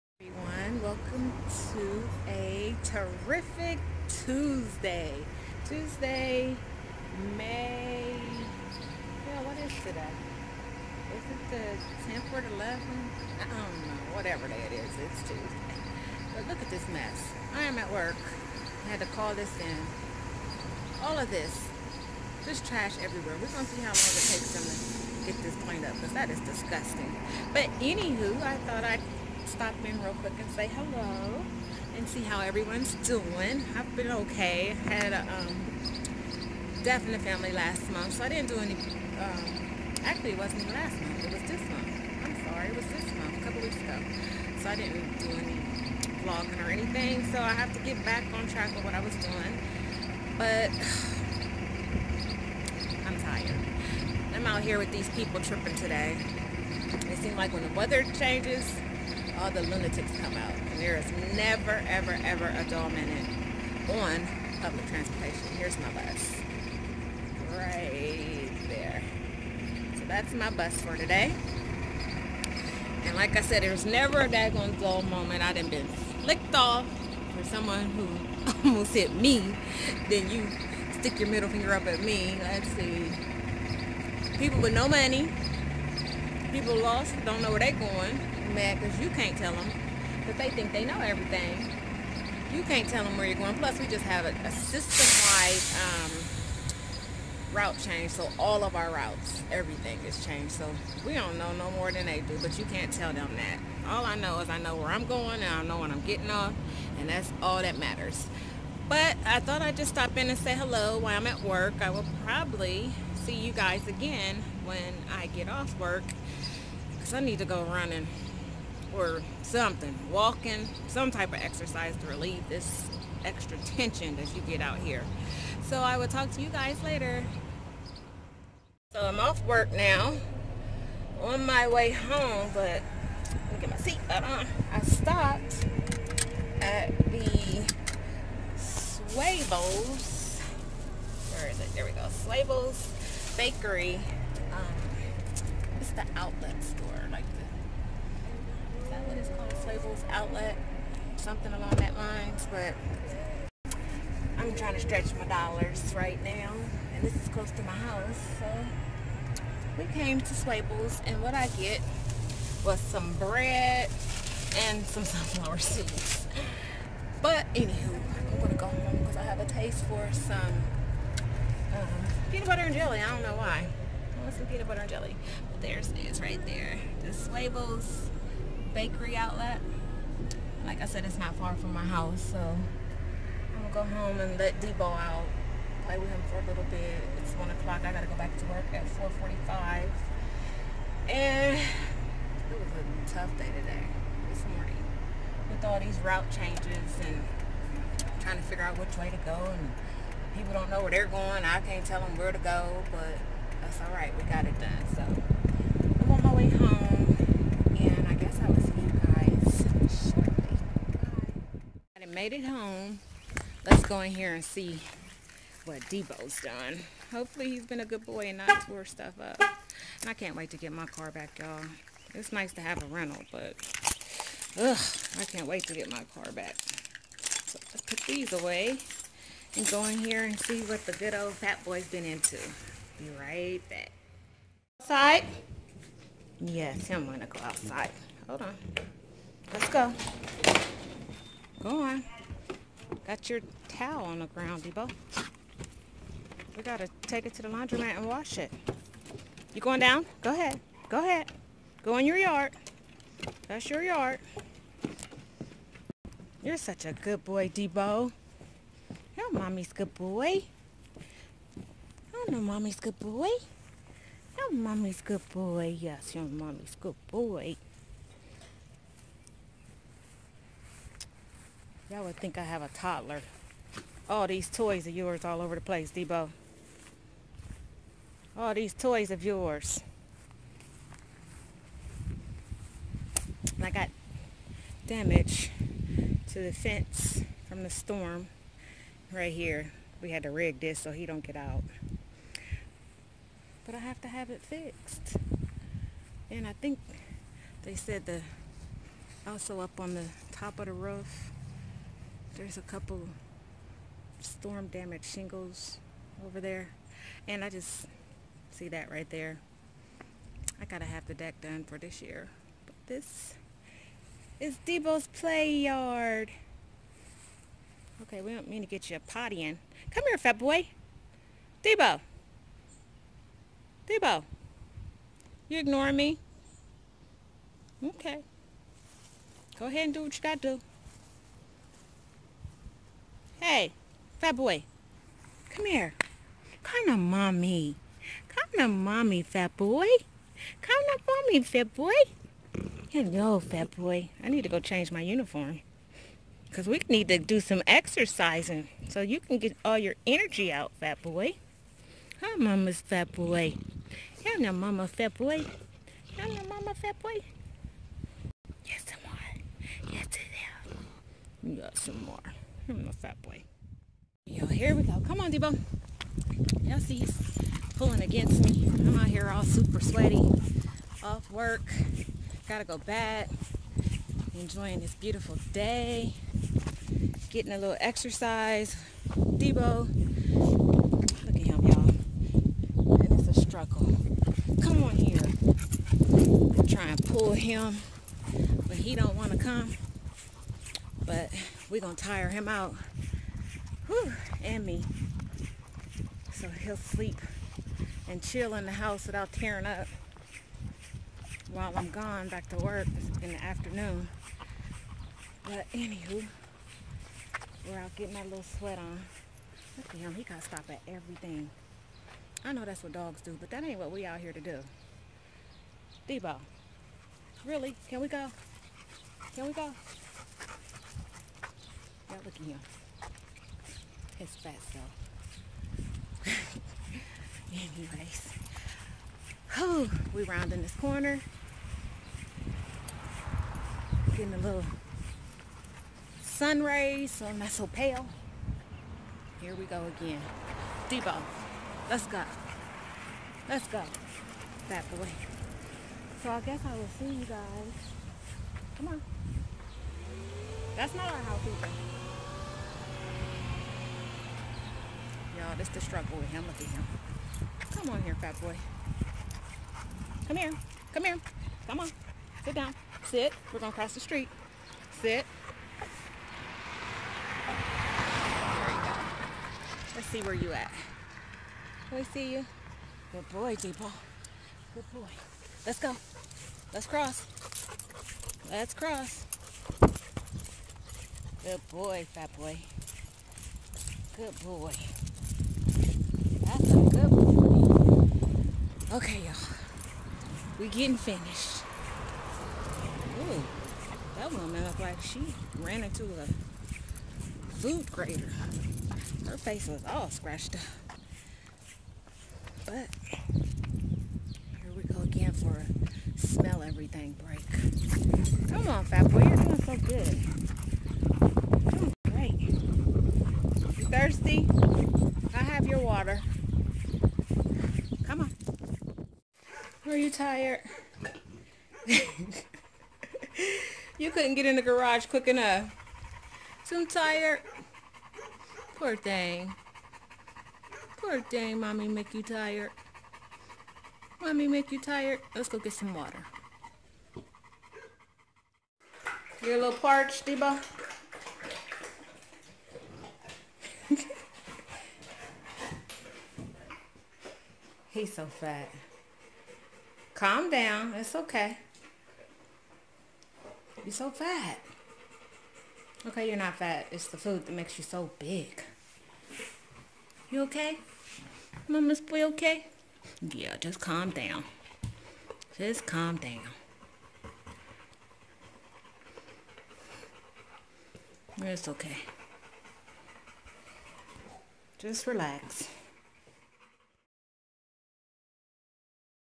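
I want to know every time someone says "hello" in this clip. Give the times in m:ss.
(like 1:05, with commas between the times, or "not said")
0:30, 1:50, 5:42.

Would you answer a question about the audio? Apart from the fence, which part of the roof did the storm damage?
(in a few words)
shingles.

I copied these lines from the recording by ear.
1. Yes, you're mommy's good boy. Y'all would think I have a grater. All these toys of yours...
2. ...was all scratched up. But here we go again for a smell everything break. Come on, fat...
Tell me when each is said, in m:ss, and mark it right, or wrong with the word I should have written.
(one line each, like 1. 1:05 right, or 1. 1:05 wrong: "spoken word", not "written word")
1. 4:25 wrong: "toddler", not "grater"
2. 8:19 right.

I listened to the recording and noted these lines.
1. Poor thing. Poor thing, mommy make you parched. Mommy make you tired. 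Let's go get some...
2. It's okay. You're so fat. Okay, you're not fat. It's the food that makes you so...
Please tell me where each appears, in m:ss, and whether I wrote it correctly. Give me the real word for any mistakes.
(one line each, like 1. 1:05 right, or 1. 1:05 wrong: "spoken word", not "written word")
1. 8:48 wrong: "tired", not "parched"
2. 9:10 right.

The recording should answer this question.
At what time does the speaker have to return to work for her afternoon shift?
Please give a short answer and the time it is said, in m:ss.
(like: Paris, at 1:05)
4:45, at 3:08.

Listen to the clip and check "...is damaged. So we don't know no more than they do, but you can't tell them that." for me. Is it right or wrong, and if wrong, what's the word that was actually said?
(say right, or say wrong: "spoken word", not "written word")
wrong: "changed", not "damaged".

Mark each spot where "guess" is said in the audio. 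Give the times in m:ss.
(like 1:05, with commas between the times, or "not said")
7:26.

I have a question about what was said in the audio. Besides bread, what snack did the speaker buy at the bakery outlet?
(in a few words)
sunflower seeds.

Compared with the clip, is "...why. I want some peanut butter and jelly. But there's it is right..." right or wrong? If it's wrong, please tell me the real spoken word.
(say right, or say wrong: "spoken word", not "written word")
right.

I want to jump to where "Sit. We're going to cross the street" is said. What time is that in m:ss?
7:43.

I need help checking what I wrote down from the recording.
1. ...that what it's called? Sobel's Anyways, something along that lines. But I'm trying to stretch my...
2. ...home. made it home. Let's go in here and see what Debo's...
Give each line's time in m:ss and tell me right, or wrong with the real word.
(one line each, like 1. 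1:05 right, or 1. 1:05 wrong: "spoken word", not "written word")
1. 2:28 wrong: "Outlet", not "Anyways"
2. 3:26 right.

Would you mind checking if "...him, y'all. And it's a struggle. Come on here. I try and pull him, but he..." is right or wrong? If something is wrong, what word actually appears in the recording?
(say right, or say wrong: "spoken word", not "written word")
right.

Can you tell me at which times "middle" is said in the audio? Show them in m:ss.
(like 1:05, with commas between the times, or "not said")
1:21.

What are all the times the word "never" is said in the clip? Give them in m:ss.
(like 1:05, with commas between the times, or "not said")
1:01, 1:13.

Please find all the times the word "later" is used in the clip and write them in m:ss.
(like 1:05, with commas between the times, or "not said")
2:06.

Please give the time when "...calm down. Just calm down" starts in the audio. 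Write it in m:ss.
9:23.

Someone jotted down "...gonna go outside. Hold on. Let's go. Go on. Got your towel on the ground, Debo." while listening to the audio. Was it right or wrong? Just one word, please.
right.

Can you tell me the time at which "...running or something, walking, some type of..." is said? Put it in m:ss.
1:57.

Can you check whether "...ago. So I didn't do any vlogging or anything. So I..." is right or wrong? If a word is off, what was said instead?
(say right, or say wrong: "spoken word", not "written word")
right.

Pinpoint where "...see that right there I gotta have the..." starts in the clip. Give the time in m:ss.
5:08.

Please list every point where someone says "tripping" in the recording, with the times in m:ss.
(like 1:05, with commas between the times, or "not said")
0:55.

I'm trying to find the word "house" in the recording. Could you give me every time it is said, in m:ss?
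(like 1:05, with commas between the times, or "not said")
2:37, 3:01, 6:38, 7:31.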